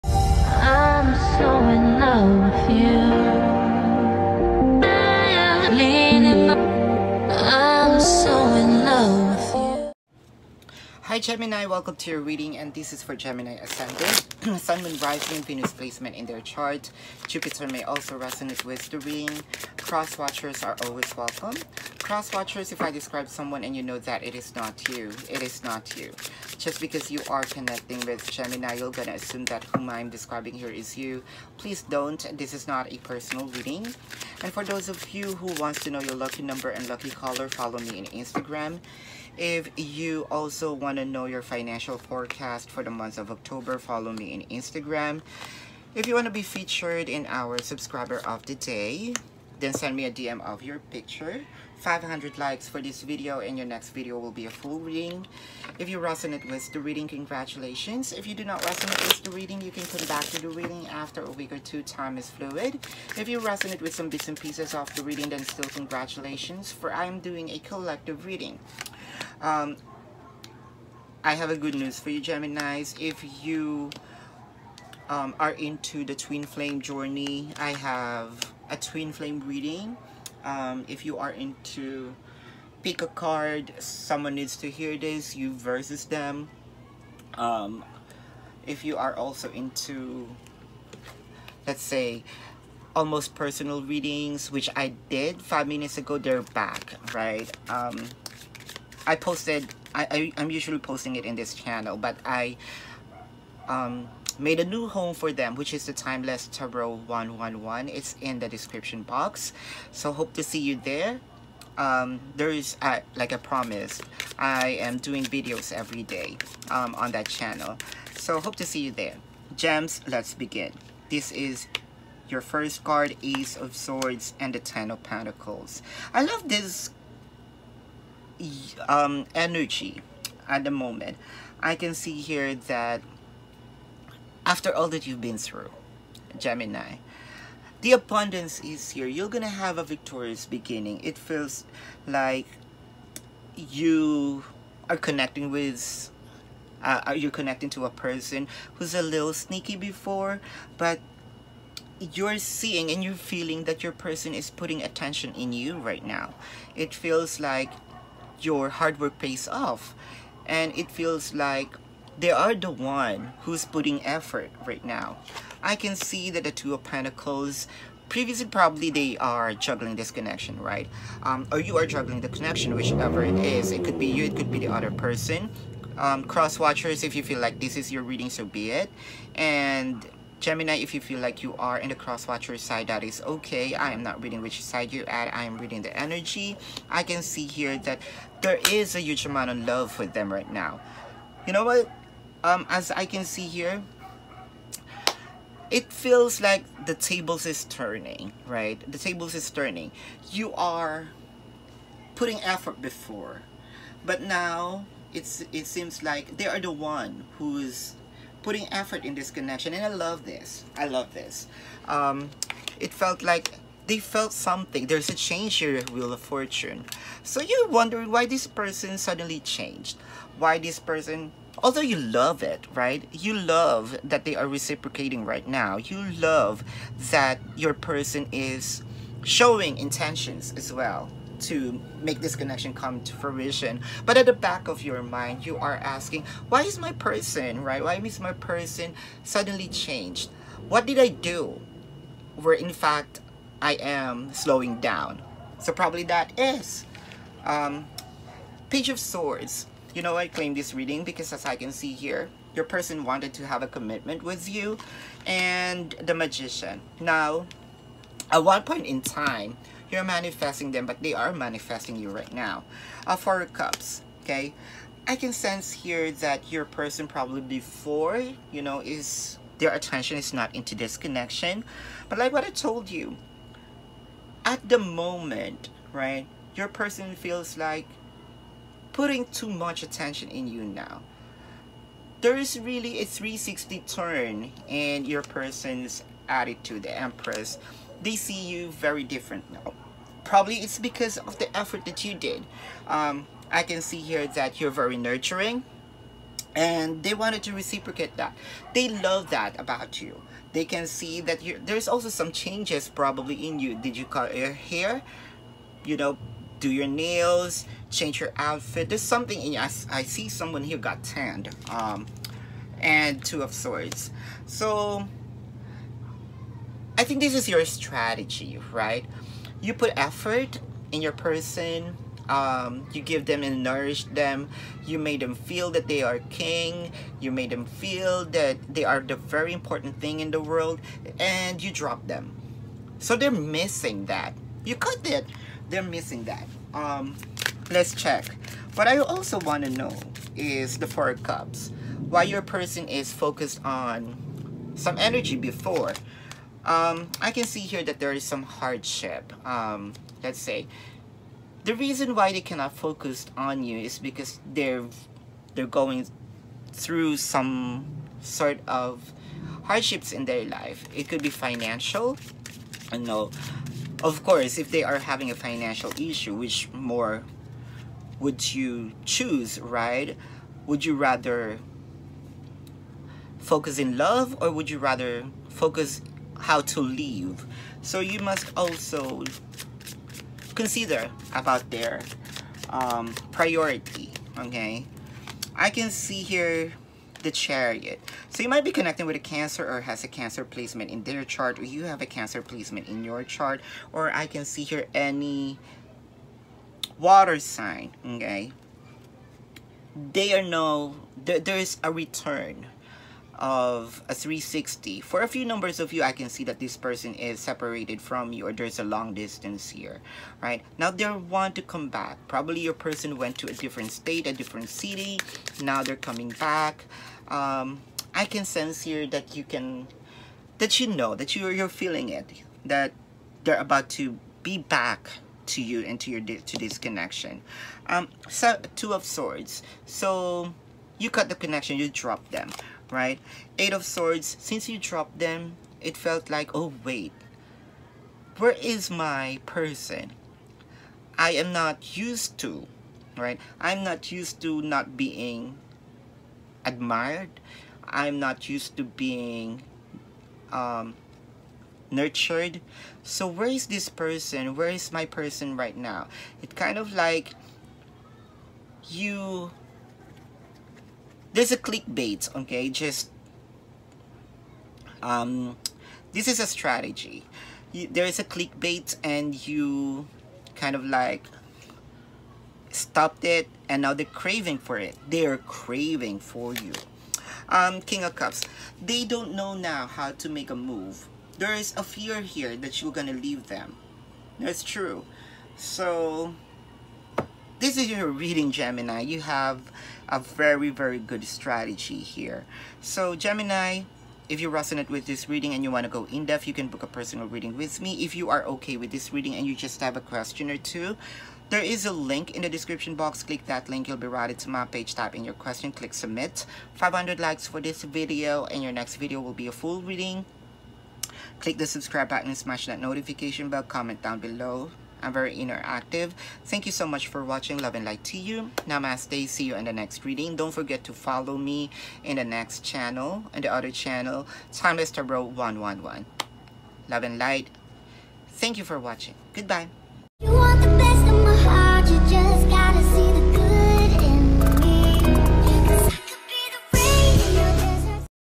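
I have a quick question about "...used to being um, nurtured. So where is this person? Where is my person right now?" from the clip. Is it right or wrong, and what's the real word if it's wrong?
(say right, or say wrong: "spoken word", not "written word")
right.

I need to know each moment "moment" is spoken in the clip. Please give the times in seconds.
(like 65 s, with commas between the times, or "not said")
130 s, 274 s.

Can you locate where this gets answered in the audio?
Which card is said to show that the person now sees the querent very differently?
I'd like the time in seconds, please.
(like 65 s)
286 s.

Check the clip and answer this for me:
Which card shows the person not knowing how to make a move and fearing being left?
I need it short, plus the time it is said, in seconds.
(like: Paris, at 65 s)
King of Cups, at 477 s.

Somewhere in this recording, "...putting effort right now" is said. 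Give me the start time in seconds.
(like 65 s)
163 s.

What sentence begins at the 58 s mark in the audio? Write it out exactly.
If you do not resonate with the reading, you can come back to the reading after a week or two.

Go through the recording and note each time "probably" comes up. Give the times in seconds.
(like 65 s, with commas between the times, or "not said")
168 s, 245 s, 267 s, 290 s, 302 s, 412 s.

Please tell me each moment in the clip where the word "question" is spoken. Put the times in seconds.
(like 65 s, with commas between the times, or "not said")
499 s, 505 s.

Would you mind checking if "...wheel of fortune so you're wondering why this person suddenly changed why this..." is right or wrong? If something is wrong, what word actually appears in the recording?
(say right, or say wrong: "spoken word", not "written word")
right.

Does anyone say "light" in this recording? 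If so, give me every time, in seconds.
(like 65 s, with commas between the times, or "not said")
517 s, 527 s.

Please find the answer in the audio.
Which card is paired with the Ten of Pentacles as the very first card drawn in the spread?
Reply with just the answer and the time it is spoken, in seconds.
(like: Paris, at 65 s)
Ace of Swords, at 123 s.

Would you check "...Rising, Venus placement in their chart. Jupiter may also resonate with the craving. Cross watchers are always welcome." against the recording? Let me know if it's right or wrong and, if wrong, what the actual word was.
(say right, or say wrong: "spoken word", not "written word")
wrong: "reading", not "craving".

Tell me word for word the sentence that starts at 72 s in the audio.
If you um, are into the twin flame journey, I have a twin flame reading.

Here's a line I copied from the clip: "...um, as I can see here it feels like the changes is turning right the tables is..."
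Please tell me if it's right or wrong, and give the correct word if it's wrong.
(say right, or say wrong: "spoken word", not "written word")
wrong: "tables", not "changes".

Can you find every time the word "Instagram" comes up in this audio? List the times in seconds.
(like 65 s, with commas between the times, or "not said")
38 s, 44 s.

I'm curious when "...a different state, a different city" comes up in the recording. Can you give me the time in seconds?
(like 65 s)
413 s.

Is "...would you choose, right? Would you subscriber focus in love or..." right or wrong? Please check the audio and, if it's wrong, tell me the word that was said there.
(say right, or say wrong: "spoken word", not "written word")
wrong: "rather", not "subscriber".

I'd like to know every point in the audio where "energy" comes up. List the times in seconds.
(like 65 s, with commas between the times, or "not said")
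129 s, 185 s, 344 s.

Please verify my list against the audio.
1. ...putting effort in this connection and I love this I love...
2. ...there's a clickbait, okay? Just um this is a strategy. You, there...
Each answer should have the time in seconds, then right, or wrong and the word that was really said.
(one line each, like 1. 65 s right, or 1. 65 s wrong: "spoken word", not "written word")
1. 208 s right
2. 461 s right.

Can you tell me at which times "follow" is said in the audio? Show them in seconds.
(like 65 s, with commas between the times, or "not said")
37 s, 43 s, 520 s.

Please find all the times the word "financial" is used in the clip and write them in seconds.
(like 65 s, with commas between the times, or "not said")
41 s, 361 s, 365 s.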